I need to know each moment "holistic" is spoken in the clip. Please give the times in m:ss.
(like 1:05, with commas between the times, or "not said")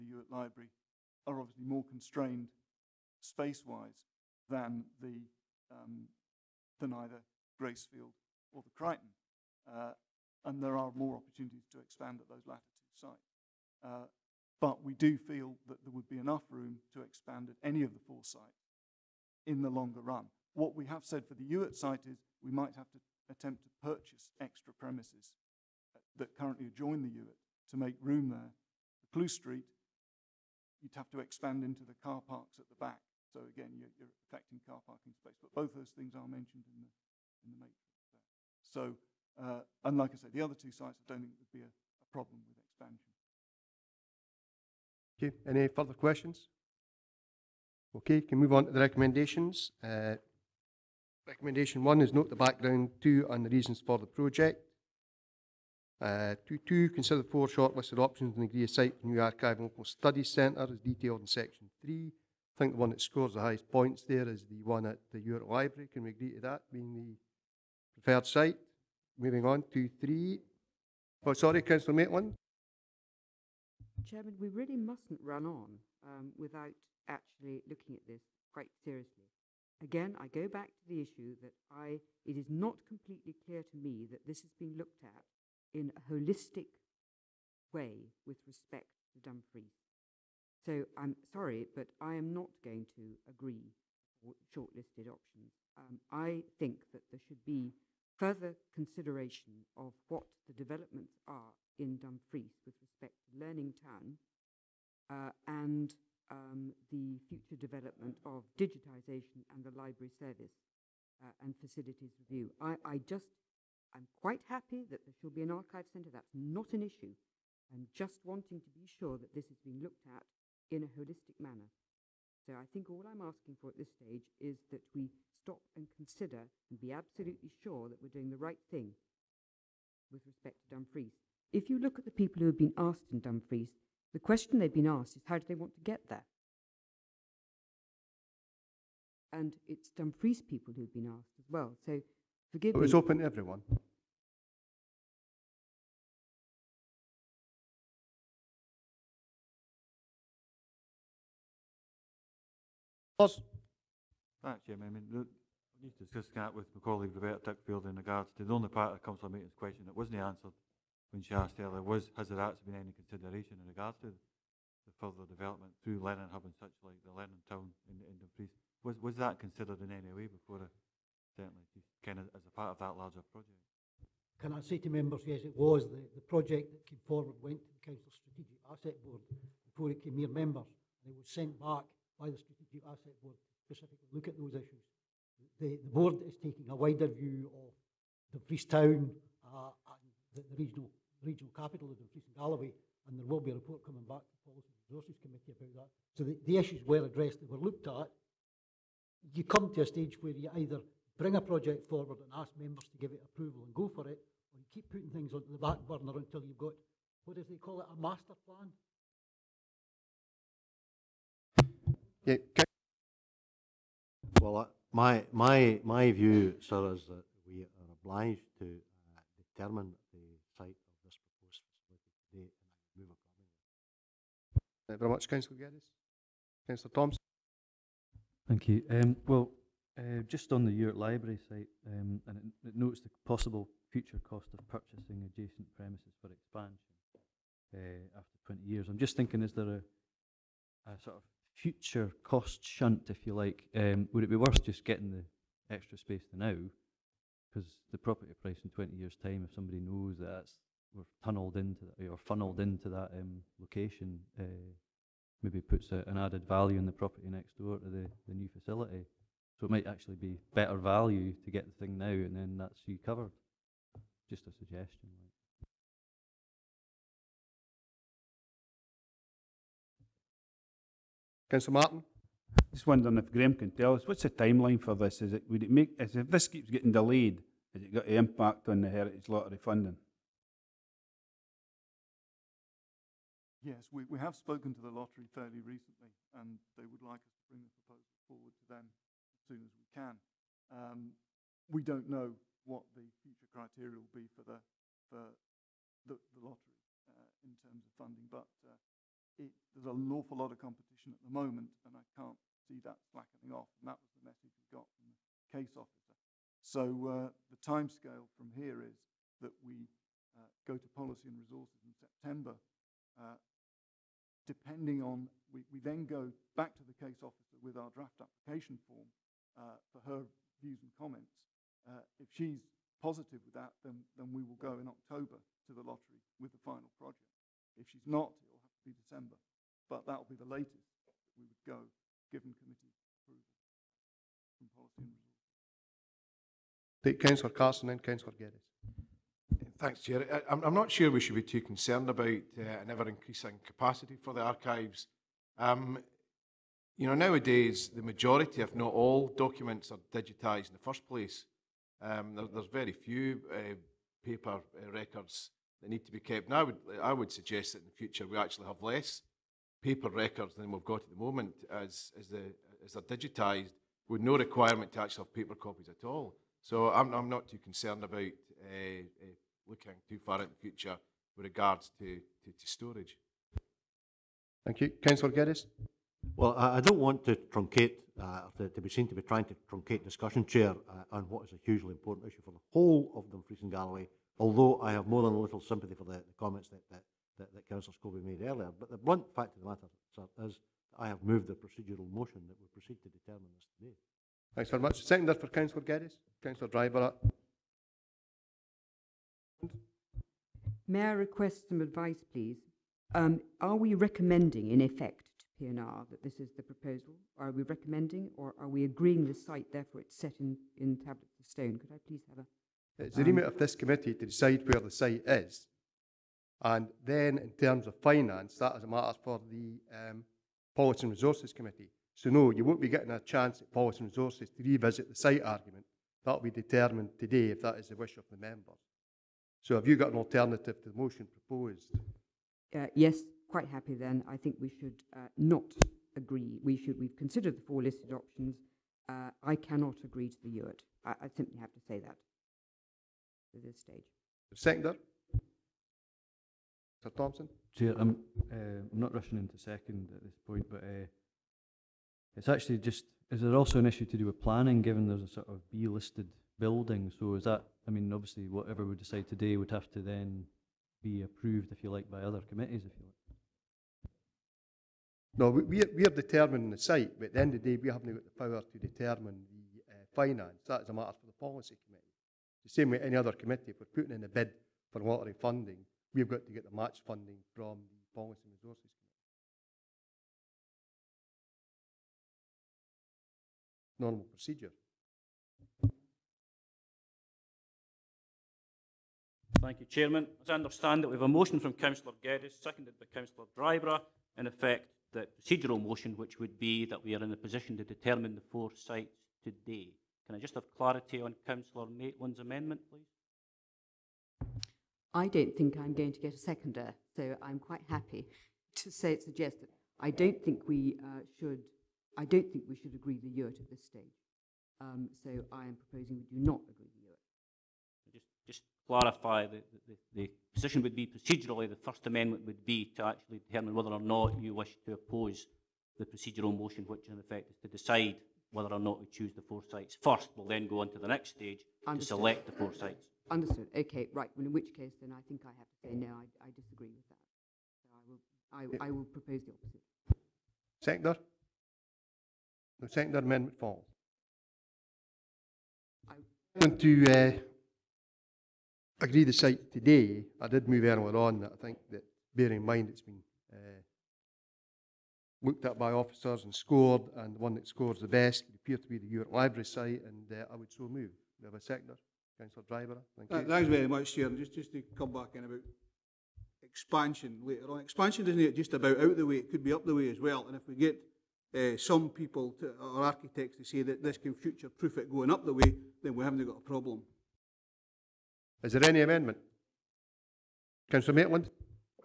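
1:26, 2:00.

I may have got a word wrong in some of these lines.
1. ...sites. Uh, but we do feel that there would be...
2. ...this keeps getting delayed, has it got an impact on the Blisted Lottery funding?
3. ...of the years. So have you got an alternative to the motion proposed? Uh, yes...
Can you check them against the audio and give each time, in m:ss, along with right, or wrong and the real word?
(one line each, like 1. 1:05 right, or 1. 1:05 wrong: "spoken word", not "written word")
1. 0:13 right
2. 4:36 wrong: "Heritage", not "Blisted"
3. 7:08 wrong: "members", not "years".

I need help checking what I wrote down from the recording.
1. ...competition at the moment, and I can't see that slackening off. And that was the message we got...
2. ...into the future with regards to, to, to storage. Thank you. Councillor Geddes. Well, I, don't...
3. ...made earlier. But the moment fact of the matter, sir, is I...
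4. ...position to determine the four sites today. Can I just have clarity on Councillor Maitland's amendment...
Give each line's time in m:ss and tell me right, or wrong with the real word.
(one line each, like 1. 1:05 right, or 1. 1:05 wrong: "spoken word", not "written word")
1. 5:00 right
2. 6:10 right
3. 6:28 wrong: "blunt", not "moment"
4. 8:17 right.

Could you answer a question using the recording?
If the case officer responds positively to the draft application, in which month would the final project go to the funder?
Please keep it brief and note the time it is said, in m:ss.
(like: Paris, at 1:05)
October, at 5:24.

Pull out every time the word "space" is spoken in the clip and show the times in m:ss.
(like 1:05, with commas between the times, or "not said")
0:03, 0:35, 4:05.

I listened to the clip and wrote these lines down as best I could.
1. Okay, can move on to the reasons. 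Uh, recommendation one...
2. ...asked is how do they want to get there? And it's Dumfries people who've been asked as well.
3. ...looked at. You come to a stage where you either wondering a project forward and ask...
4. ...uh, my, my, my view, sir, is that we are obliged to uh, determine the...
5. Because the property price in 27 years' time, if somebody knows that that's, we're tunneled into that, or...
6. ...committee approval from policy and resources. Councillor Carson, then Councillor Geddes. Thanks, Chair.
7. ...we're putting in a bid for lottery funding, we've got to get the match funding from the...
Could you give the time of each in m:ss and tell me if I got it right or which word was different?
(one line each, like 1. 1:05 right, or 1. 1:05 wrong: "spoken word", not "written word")
1. 0:47 wrong: "recommendations", not "reasons"
2. 2:14 right
3. 3:17 wrong: "bring", not "wondering"
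4. 3:34 right
5. 4:07 wrong: "20", not "27"
6. 5:32 right
7. 7:53 right.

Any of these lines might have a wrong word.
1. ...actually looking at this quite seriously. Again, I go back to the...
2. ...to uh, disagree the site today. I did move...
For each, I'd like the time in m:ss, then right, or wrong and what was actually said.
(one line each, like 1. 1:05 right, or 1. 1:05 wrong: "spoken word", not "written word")
1. 1:17 right
2. 9:06 wrong: "agree", not "disagree".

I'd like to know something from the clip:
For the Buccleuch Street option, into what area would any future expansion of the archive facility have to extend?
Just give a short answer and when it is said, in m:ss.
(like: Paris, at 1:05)
The car parks at the back, at 0:32.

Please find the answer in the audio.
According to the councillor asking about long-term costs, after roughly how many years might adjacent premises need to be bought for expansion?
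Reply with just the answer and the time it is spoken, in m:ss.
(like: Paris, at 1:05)
20 years, at 3:58.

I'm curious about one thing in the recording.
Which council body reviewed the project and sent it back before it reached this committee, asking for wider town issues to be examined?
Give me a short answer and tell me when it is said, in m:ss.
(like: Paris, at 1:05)
Council Strategic Asset Board, at 2:57.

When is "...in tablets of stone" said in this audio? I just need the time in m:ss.
6:50.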